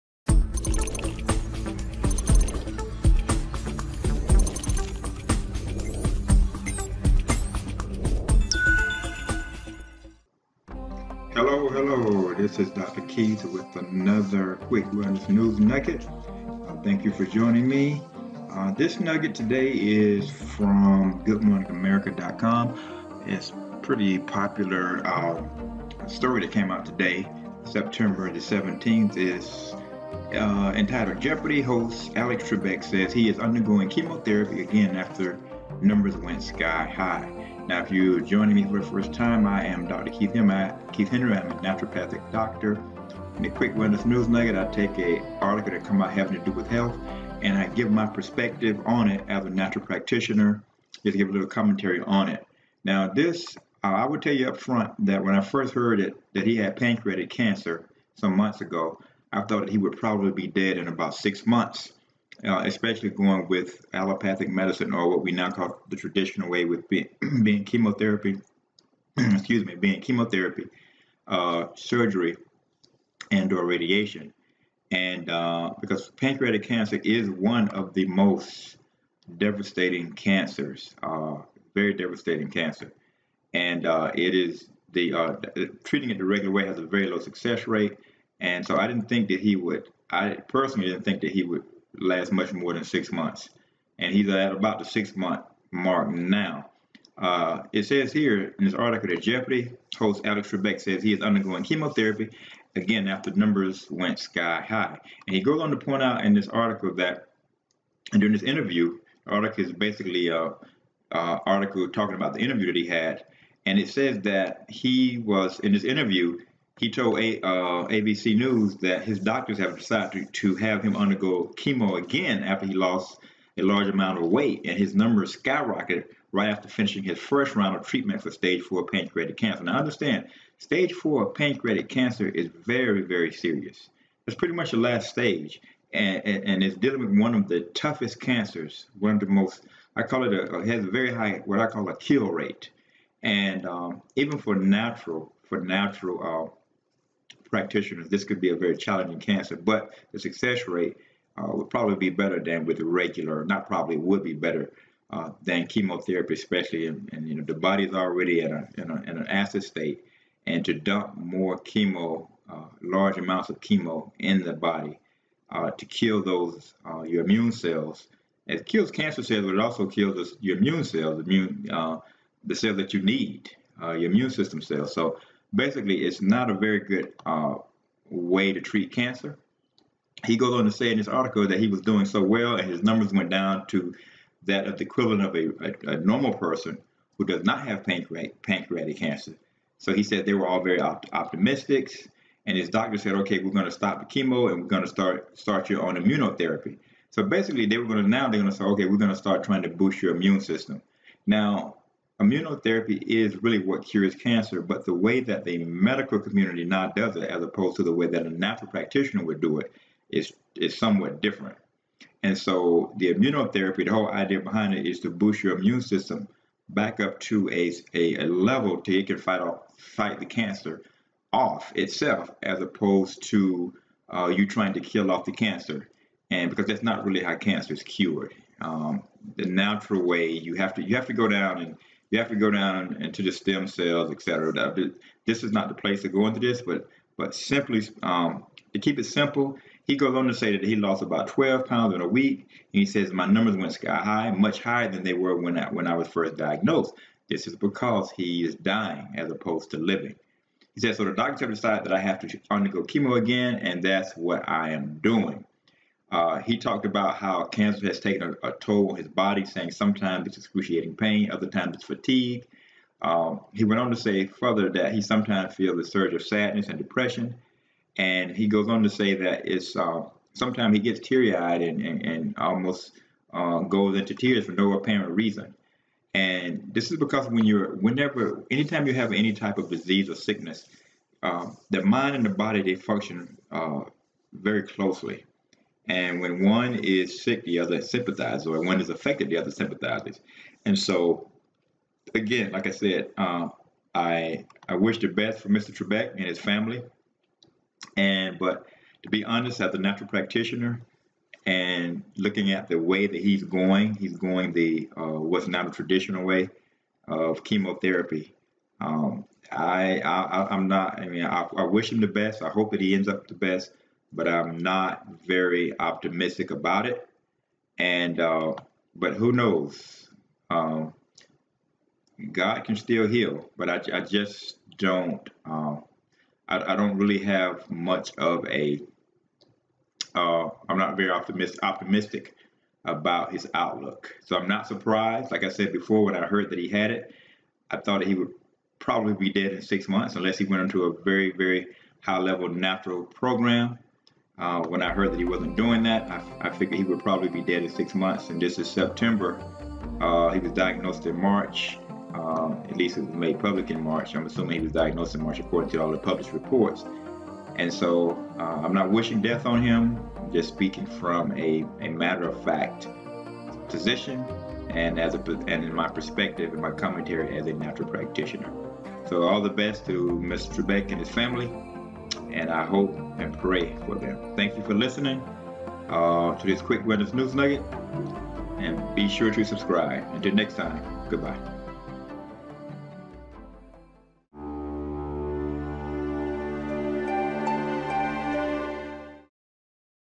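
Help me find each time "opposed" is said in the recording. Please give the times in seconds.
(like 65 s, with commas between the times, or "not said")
207 s, 222 s, 249 s.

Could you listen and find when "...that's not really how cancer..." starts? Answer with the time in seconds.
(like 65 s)
226 s.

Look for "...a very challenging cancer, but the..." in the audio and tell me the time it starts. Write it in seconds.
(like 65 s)
148 s.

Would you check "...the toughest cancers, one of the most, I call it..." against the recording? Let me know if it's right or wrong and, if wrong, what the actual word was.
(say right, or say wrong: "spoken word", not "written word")
right.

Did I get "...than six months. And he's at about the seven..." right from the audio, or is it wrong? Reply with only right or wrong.
wrong.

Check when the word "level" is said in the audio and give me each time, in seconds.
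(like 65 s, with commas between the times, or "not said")
218 s, 342 s.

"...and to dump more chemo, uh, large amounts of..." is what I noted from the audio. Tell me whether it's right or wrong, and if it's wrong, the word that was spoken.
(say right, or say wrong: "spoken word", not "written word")
right.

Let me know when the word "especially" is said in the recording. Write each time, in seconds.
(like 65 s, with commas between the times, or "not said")
62 s, 156 s.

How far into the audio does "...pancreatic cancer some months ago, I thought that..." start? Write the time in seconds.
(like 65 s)
56 s.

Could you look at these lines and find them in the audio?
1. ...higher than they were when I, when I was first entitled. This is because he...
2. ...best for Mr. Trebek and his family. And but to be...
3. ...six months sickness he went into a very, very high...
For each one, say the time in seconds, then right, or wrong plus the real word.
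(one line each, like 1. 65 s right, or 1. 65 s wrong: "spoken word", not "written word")
1. 244 s wrong: "diagnosed", not "entitled"
2. 295 s right
3. 339 s wrong: "unless", not "sickness".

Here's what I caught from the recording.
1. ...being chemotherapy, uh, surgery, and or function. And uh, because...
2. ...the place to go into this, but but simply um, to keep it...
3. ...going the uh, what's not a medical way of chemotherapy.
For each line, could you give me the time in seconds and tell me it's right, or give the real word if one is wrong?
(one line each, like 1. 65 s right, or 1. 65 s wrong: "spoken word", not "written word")
1. 69 s wrong: "radiation", not "function"
2. 235 s right
3. 304 s wrong: "traditional", not "medical".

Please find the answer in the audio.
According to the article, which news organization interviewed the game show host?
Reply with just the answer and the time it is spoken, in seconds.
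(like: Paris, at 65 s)
ABC News, at 117 s.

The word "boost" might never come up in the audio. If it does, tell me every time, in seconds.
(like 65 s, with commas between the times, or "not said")
199 s, 215 s.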